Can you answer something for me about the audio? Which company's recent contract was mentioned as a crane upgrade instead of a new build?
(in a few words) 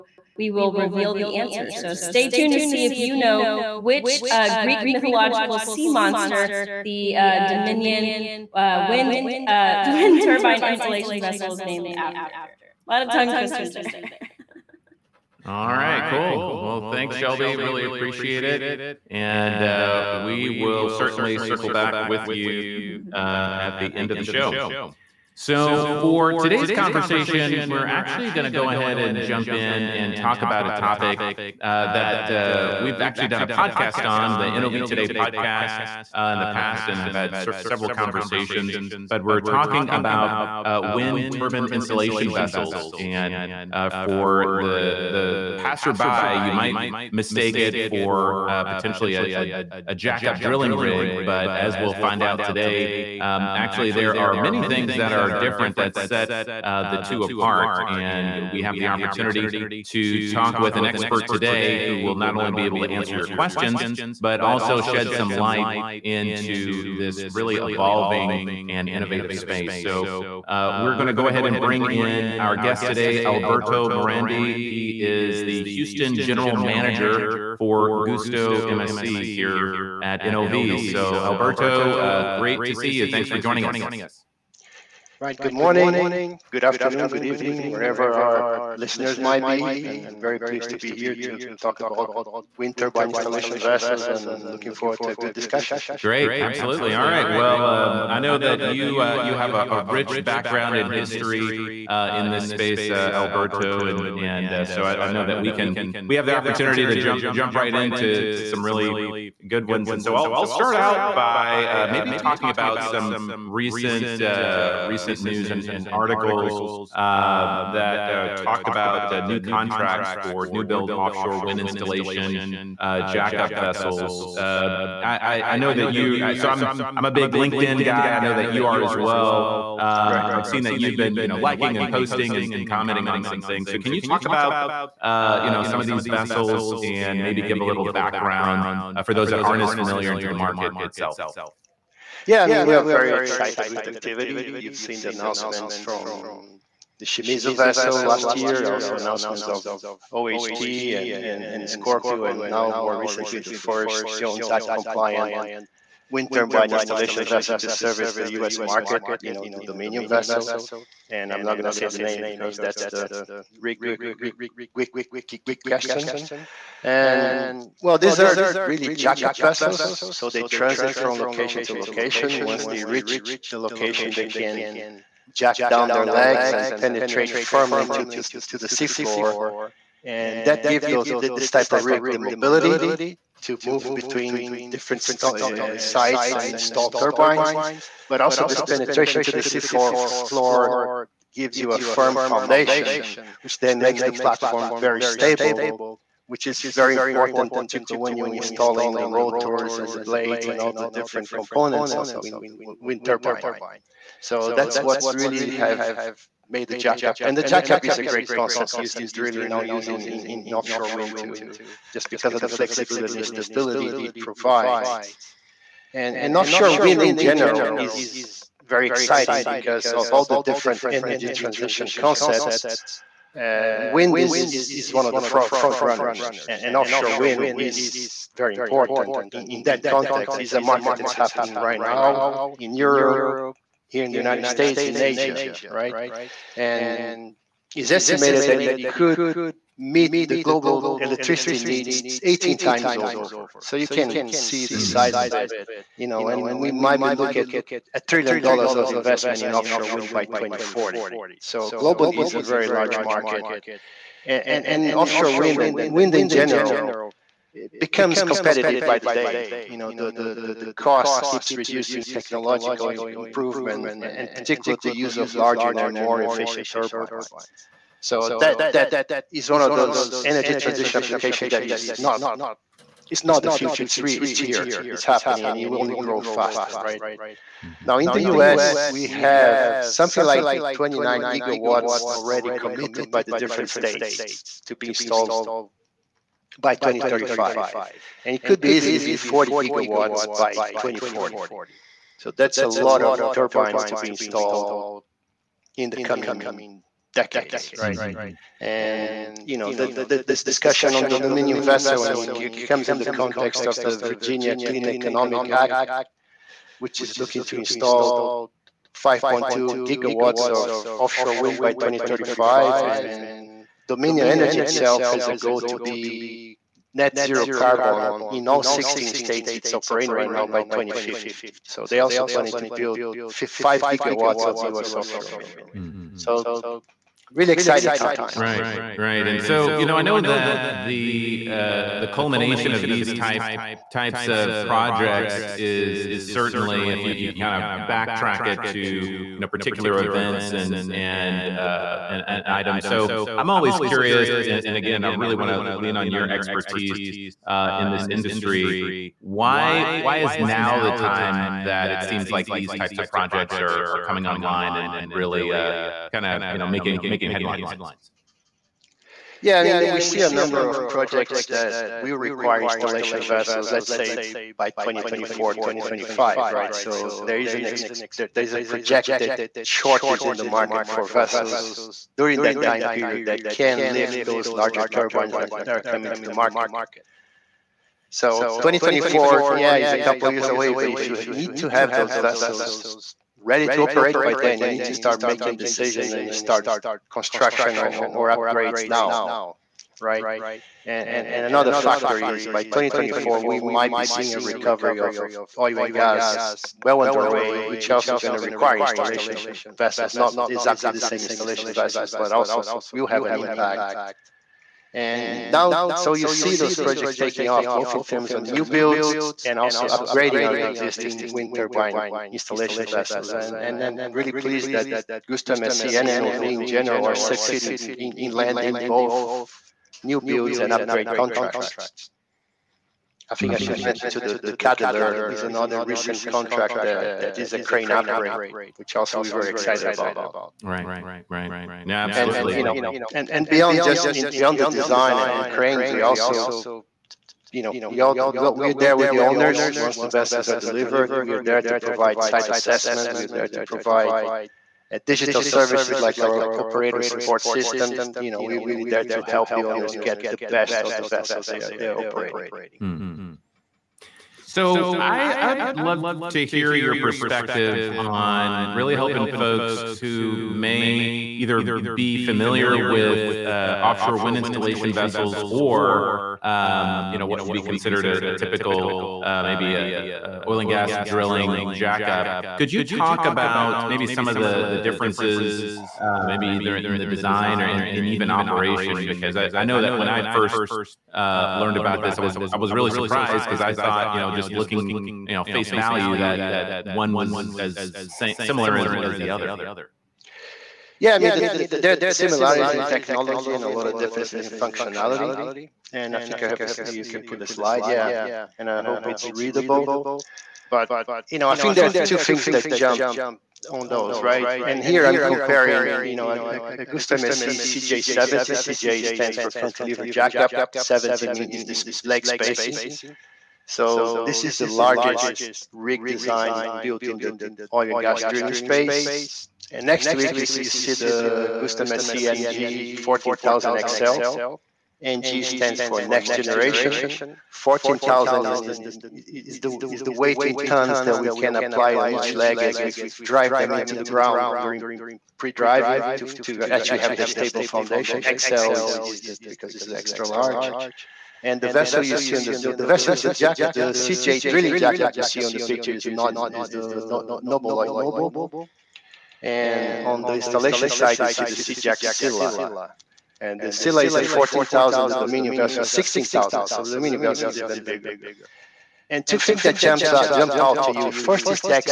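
Cadeler.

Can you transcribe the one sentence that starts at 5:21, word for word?
So they also planning to build five gigawatts of U.S.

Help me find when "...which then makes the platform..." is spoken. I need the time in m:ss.
3:13.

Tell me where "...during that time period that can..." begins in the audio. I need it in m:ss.
6:12.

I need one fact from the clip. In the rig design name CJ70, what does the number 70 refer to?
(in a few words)
leg spacing.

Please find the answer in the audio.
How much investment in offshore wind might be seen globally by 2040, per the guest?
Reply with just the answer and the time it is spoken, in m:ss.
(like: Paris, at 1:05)
a trillion dollars, at 4:07.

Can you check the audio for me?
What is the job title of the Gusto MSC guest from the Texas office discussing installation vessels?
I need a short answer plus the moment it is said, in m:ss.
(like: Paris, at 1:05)
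Houston General Manager, at 1:15.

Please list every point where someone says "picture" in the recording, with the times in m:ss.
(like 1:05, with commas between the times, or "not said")
9:05.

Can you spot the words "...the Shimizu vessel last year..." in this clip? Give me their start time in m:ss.
2:26.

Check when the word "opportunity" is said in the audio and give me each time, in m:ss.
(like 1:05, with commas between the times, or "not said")
0:58, 1:46.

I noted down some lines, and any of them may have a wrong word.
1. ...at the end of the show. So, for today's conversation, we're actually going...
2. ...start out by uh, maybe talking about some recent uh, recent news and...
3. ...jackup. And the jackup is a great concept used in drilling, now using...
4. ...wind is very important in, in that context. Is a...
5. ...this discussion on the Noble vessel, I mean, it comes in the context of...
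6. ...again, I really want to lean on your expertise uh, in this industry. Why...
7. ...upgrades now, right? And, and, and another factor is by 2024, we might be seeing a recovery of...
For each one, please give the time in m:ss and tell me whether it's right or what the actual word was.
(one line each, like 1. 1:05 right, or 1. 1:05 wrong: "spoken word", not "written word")
1. 0:23 right
2. 1:50 right
3. 3:26 right
4. 3:47 right
5. 5:00 wrong: "Dominion", not "Noble"
6. 5:44 right
7. 6:28 right.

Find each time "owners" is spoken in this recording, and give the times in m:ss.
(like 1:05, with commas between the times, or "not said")
7:19, 7:29.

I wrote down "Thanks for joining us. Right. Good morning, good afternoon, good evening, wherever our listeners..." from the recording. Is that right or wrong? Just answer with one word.
right.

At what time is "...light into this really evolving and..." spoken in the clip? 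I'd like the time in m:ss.
1:05.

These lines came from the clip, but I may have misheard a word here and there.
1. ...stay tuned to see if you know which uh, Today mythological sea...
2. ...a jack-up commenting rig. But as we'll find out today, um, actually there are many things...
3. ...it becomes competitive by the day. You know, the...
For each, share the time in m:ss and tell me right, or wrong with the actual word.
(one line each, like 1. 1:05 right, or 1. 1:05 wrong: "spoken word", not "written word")
1. 0:01 wrong: "Greek", not "Today"
2. 0:49 wrong: "drilling", not "commenting"
3. 4:17 right.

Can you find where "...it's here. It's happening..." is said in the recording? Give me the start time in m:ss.
4:34.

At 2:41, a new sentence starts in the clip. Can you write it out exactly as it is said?
And I'm not going to say the name because that's the rig, rig, question.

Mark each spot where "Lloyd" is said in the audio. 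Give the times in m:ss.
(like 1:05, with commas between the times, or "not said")
9:07.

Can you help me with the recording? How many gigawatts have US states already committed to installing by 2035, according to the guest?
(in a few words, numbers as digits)
29.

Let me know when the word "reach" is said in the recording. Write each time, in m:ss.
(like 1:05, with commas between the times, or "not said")
2:52.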